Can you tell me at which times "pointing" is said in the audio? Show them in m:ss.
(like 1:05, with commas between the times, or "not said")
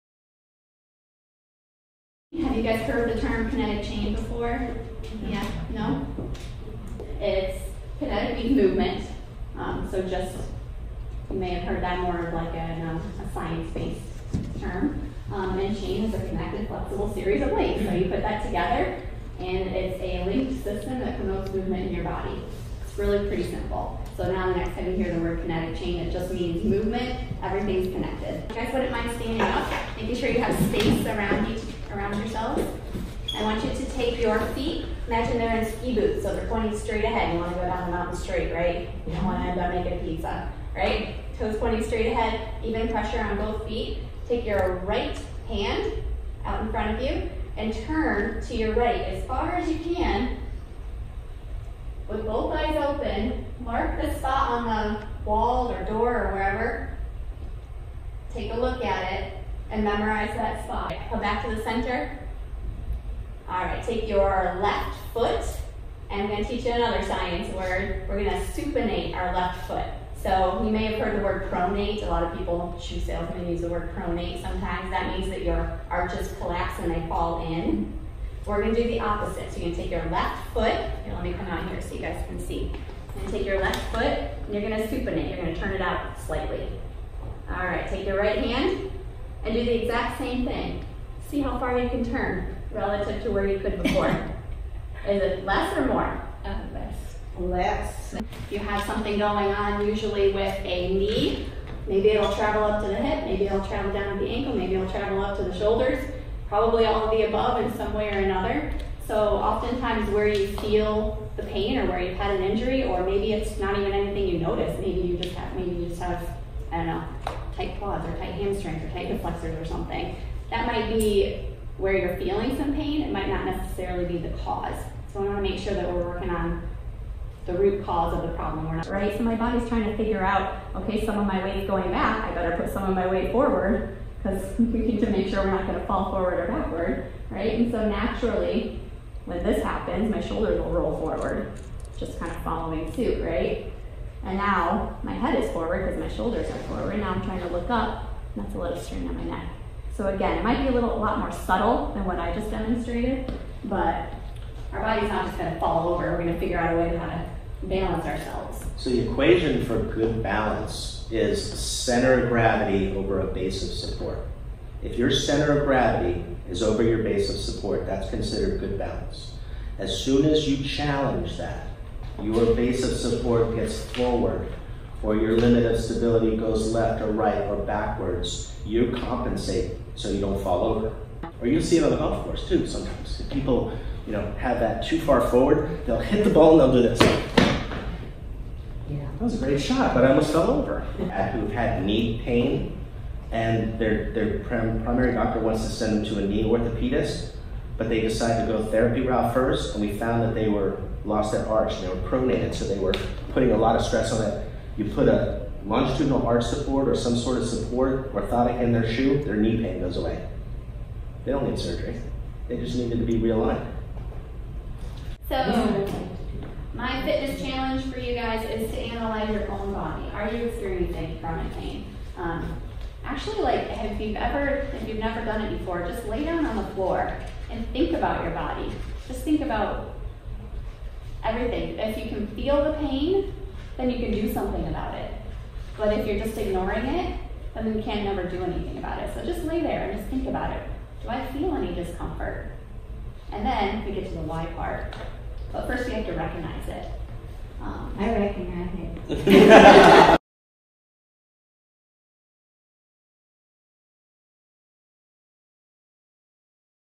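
0:36, 0:41.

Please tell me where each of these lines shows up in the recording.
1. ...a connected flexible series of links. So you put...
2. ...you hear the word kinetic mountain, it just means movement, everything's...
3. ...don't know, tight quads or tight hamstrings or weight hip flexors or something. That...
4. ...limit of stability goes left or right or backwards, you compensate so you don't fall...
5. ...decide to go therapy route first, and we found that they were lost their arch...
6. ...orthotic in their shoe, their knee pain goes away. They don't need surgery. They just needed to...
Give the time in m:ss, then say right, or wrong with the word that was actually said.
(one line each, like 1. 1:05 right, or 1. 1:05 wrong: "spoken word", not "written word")
1. 0:16 right
2. 0:24 wrong: "chain", not "mountain"
3. 1:56 wrong: "tight", not "weight"
4. 2:55 right
5. 3:18 right
6. 3:28 right.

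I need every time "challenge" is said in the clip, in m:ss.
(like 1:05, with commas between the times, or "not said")
2:50, 3:37.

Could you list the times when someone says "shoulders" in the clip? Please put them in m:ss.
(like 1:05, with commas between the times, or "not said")
1:45, 2:20, 2:26.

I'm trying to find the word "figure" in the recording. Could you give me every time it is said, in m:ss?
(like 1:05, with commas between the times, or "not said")
2:09, 2:36.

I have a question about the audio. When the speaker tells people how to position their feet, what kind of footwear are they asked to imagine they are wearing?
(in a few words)
ski boots.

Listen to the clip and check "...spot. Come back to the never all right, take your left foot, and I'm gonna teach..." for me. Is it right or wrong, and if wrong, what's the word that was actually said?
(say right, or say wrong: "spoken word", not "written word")
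wrong: "center", not "never".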